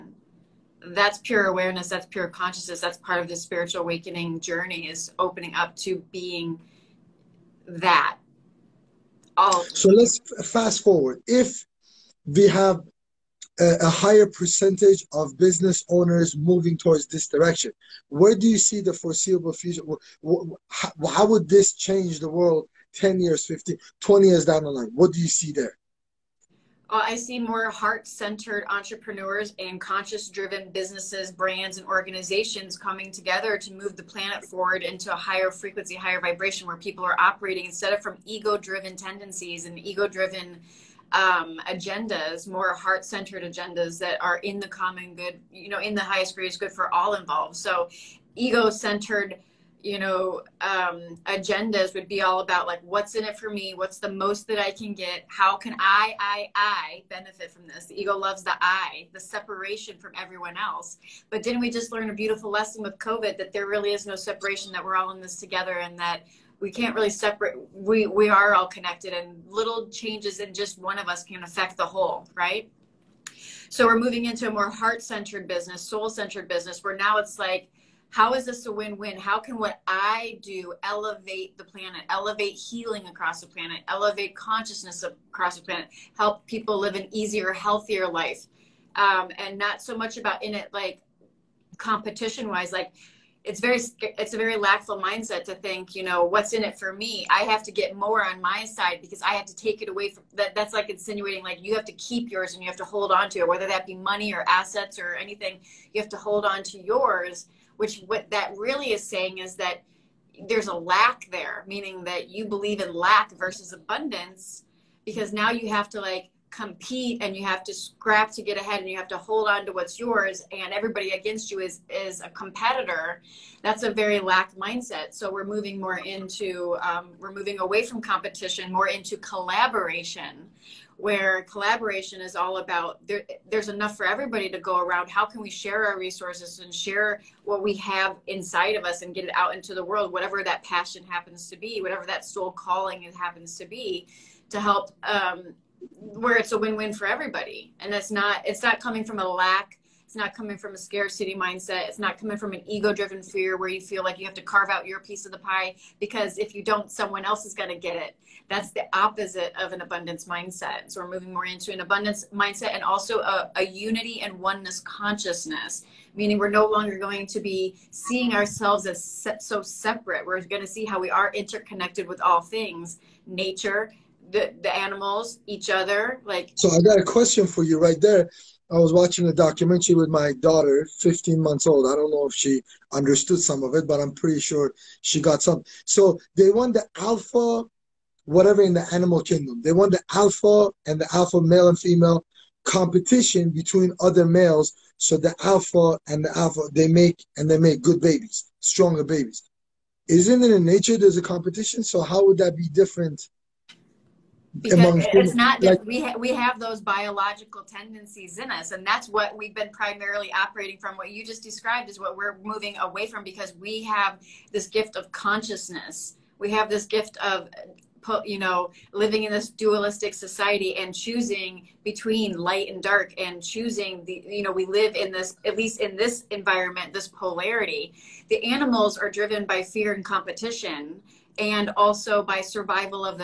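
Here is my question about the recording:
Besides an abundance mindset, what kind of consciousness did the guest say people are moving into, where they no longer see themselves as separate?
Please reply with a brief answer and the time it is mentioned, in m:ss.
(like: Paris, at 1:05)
unity and oneness consciousness, at 2:43.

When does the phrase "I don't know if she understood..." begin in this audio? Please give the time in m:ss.
3:01.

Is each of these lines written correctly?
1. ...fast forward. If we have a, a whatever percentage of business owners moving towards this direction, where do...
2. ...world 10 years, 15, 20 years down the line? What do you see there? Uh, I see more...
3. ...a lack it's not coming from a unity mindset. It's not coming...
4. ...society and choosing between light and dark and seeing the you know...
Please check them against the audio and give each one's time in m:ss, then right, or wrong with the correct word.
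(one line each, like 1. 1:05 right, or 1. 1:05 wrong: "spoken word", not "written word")
1. 0:10 wrong: "higher", not "whatever"
2. 0:22 right
3. 2:29 wrong: "scarcity", not "unity"
4. 3:40 wrong: "choosing", not "seeing".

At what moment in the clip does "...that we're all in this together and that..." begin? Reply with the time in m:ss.
1:04.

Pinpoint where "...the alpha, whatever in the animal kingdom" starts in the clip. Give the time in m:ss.
3:06.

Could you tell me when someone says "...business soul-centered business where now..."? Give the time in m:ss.
1:15.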